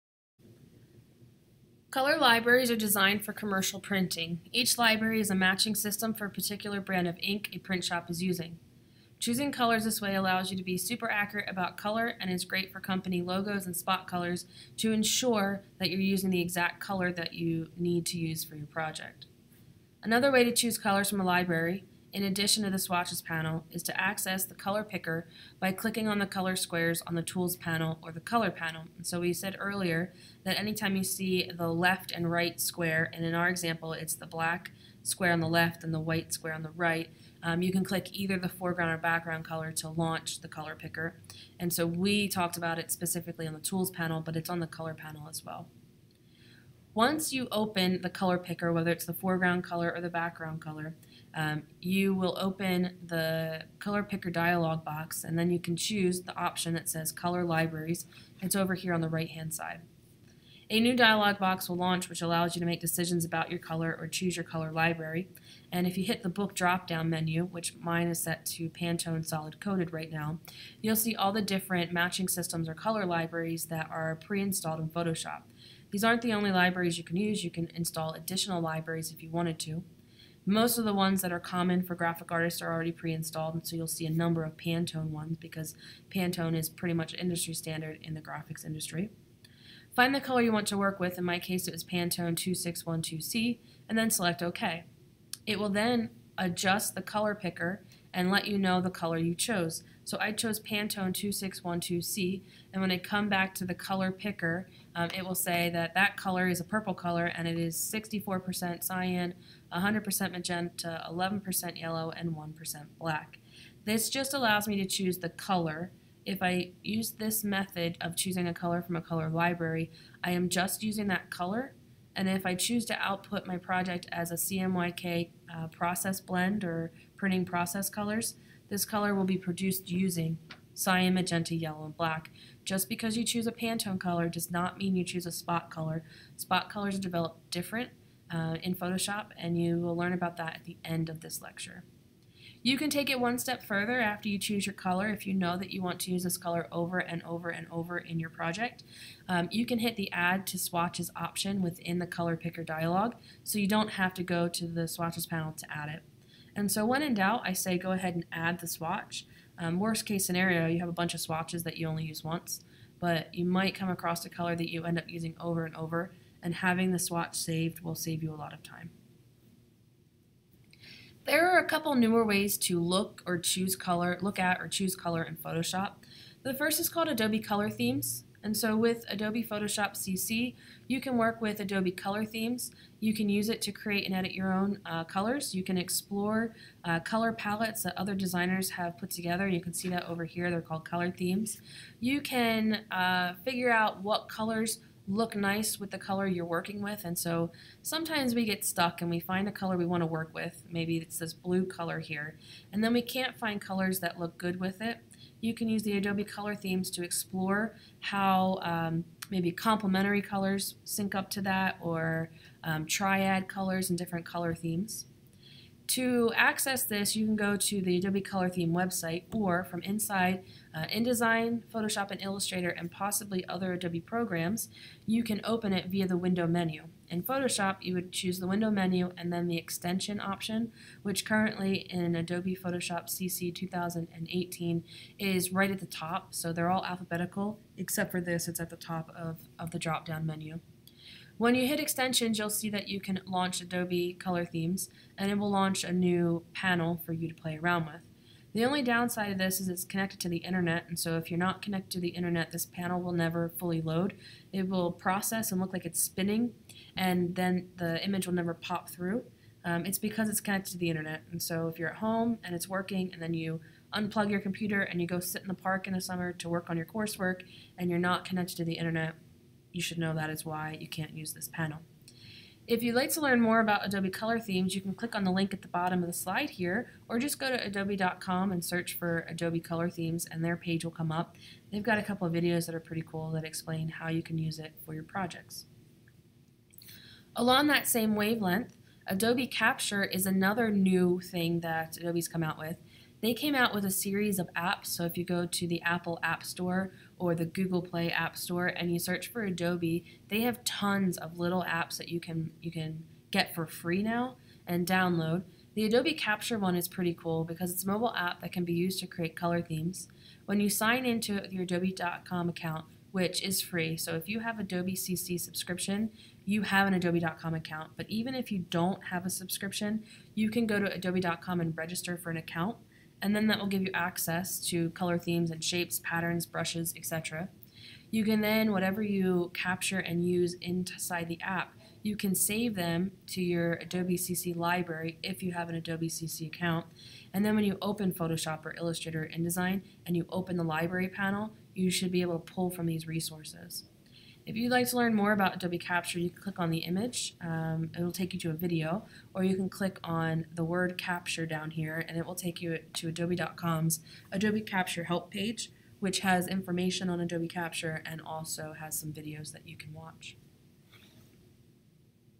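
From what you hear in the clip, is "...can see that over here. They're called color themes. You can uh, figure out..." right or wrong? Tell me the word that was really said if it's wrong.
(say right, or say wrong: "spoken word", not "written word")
right.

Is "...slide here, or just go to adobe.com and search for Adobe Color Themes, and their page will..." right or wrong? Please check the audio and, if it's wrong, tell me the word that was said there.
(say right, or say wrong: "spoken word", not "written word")
right.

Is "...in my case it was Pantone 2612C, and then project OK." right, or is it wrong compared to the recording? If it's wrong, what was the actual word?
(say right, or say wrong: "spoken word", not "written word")
wrong: "select", not "project".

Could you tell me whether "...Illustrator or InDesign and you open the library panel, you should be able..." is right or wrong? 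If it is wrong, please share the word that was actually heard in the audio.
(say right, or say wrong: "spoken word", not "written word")
right.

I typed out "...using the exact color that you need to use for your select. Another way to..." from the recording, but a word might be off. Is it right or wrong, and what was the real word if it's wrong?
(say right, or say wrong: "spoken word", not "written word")
wrong: "project", not "select".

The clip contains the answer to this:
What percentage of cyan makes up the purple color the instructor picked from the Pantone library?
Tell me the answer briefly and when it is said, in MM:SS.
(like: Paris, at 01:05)
64%, at 01:47.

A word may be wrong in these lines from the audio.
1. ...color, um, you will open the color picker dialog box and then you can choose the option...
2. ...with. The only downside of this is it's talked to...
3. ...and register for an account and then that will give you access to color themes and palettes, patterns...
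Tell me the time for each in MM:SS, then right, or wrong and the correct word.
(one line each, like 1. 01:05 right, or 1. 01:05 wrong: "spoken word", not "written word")
1. 00:50 right
2. 04:07 wrong: "connected", not "talked"
3. 05:21 wrong: "shapes", not "palettes".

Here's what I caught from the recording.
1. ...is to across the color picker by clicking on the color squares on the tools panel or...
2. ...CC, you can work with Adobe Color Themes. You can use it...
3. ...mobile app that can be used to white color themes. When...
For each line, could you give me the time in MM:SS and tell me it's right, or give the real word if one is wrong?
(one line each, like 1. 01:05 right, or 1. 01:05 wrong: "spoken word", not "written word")
1. 00:23 wrong: "access", not "across"
2. 02:59 right
3. 05:07 wrong: "create", not "white".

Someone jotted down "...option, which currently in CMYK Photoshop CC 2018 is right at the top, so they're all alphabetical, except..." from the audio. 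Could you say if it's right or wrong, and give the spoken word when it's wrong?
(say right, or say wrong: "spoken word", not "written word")
wrong: "Adobe", not "CMYK".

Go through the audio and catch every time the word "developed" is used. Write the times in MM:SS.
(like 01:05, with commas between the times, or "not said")
02:17.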